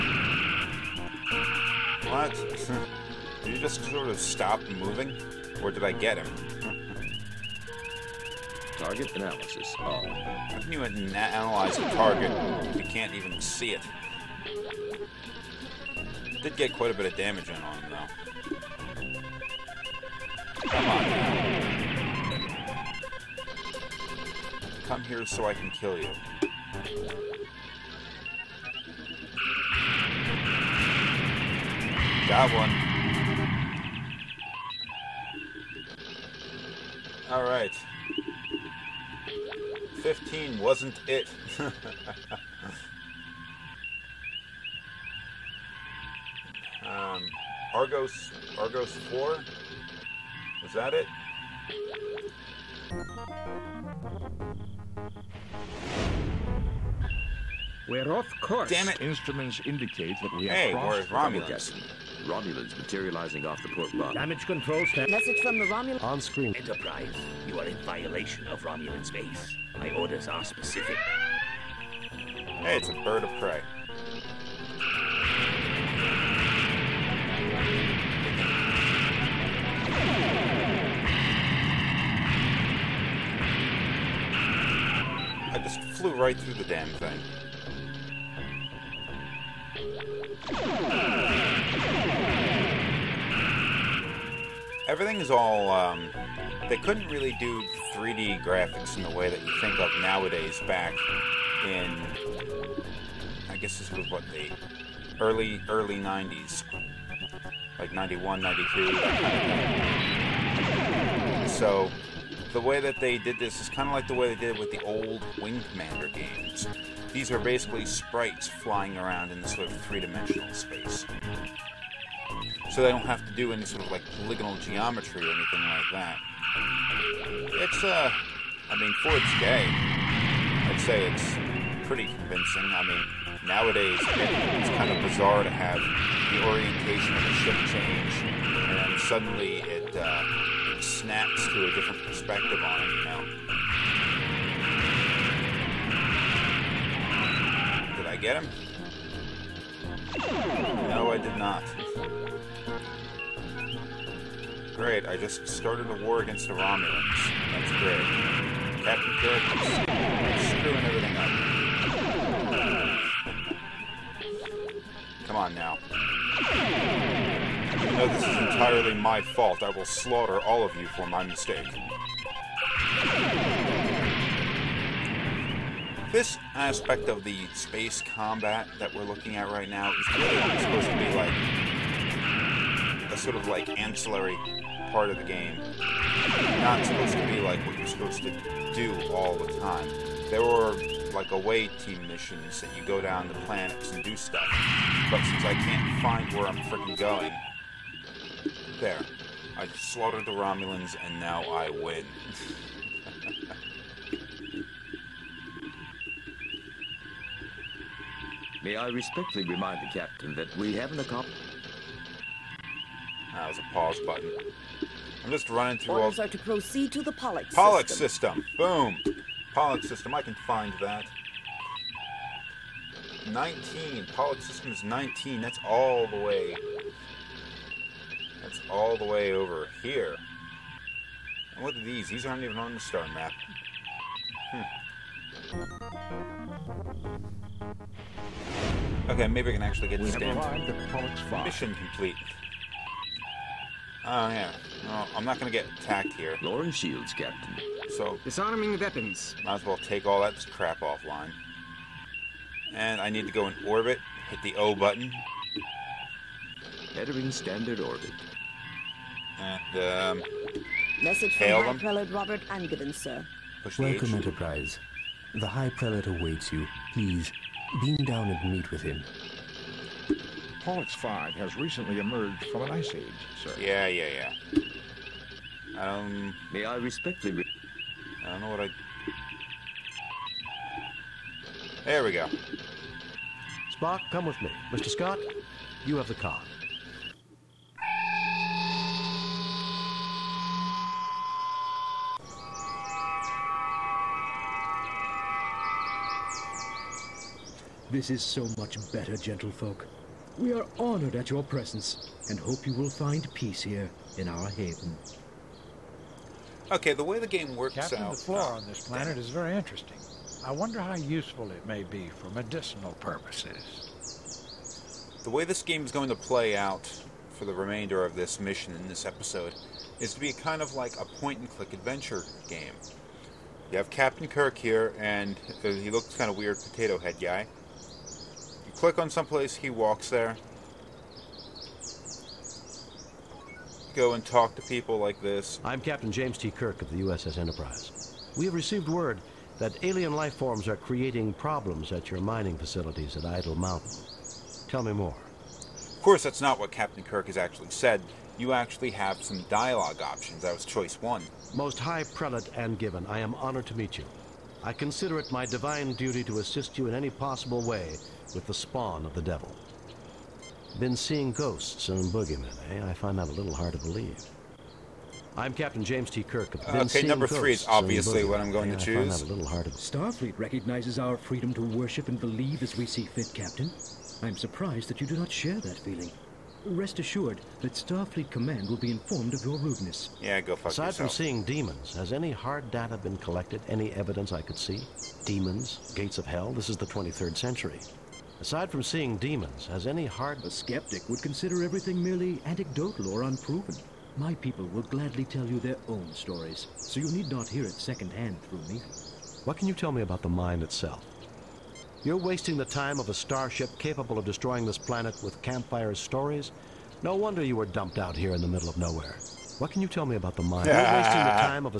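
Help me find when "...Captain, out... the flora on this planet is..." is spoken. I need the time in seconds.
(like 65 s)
307 s.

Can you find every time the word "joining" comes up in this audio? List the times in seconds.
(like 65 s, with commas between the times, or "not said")
not said.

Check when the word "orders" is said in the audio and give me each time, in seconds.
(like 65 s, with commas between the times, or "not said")
69 s, 215 s.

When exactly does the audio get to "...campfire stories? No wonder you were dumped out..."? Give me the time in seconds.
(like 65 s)
405 s.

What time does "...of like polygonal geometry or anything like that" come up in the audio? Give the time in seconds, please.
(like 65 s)
123 s.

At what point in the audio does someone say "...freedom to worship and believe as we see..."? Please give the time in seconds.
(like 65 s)
371 s.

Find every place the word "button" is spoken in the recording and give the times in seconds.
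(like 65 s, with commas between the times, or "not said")
214 s, 254 s.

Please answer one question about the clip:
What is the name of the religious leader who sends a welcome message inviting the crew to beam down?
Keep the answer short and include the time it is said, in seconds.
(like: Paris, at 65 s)
Robert Angiven, at 262 s.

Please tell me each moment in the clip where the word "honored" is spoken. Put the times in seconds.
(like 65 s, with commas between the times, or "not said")
300 s, 353 s.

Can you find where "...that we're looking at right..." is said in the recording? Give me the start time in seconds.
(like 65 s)
178 s.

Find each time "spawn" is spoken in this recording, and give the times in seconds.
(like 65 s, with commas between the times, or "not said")
358 s.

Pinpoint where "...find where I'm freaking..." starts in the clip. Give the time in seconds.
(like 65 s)
196 s.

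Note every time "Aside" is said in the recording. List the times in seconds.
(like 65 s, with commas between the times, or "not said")
380 s, 388 s.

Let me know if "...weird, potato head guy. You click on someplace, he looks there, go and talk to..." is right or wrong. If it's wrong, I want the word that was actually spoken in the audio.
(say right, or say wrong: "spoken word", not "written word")
wrong: "walks", not "looks".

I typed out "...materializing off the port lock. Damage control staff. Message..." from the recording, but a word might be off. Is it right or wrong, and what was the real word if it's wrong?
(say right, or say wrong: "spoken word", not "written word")
right.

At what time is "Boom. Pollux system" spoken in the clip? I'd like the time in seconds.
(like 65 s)
218 s.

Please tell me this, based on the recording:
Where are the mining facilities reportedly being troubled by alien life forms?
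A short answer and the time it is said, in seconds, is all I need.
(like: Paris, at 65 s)
Idle Mountain, at 343 s.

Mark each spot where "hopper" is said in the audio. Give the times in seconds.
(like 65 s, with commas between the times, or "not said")
not said.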